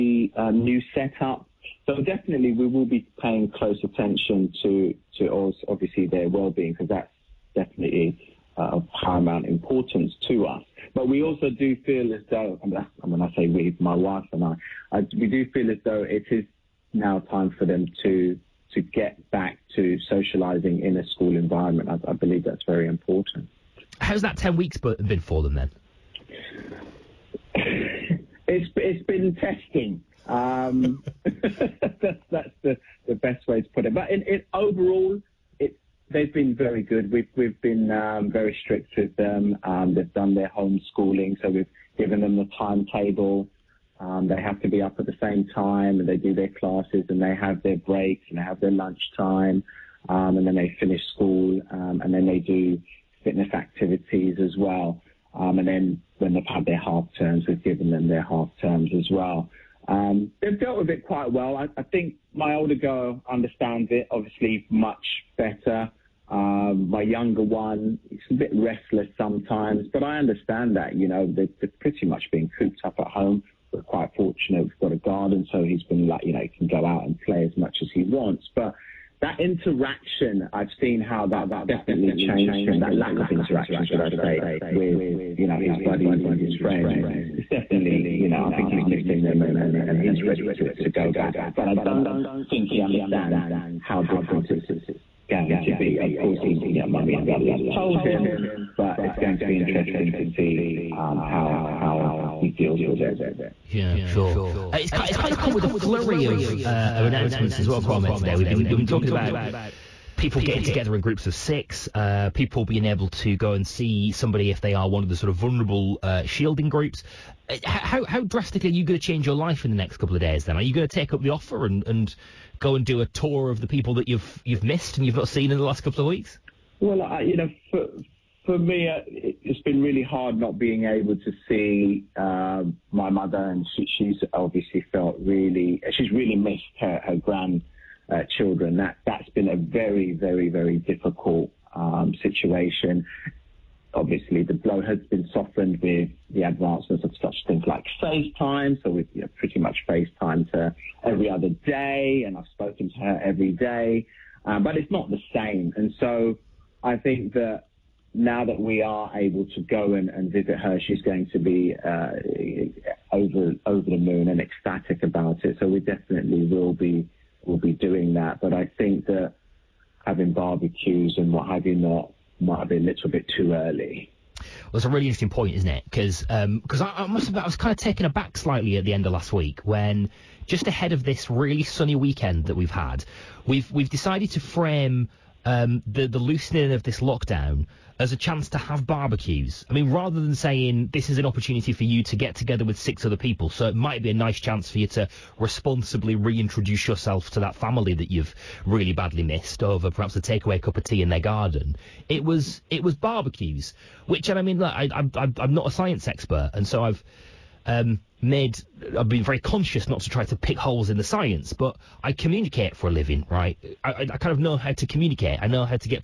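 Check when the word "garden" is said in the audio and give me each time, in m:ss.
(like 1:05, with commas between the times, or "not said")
1:14, 3:21.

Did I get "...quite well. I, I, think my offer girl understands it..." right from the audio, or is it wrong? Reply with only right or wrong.
wrong.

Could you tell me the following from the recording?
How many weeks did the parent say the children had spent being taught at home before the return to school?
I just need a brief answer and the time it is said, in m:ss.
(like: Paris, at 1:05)
10, at 0:24.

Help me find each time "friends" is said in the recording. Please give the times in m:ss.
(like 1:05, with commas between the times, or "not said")
1:26.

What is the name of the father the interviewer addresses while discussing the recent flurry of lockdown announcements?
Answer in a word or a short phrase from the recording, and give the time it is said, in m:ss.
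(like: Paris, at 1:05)
Kwame, at 1:47.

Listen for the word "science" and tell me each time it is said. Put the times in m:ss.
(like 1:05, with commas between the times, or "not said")
3:25, 3:31.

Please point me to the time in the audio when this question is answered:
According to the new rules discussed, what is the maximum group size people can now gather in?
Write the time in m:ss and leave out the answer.
1:50.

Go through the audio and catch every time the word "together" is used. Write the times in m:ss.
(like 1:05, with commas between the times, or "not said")
1:50, 3:12.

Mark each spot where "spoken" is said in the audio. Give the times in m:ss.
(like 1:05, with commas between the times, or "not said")
2:32.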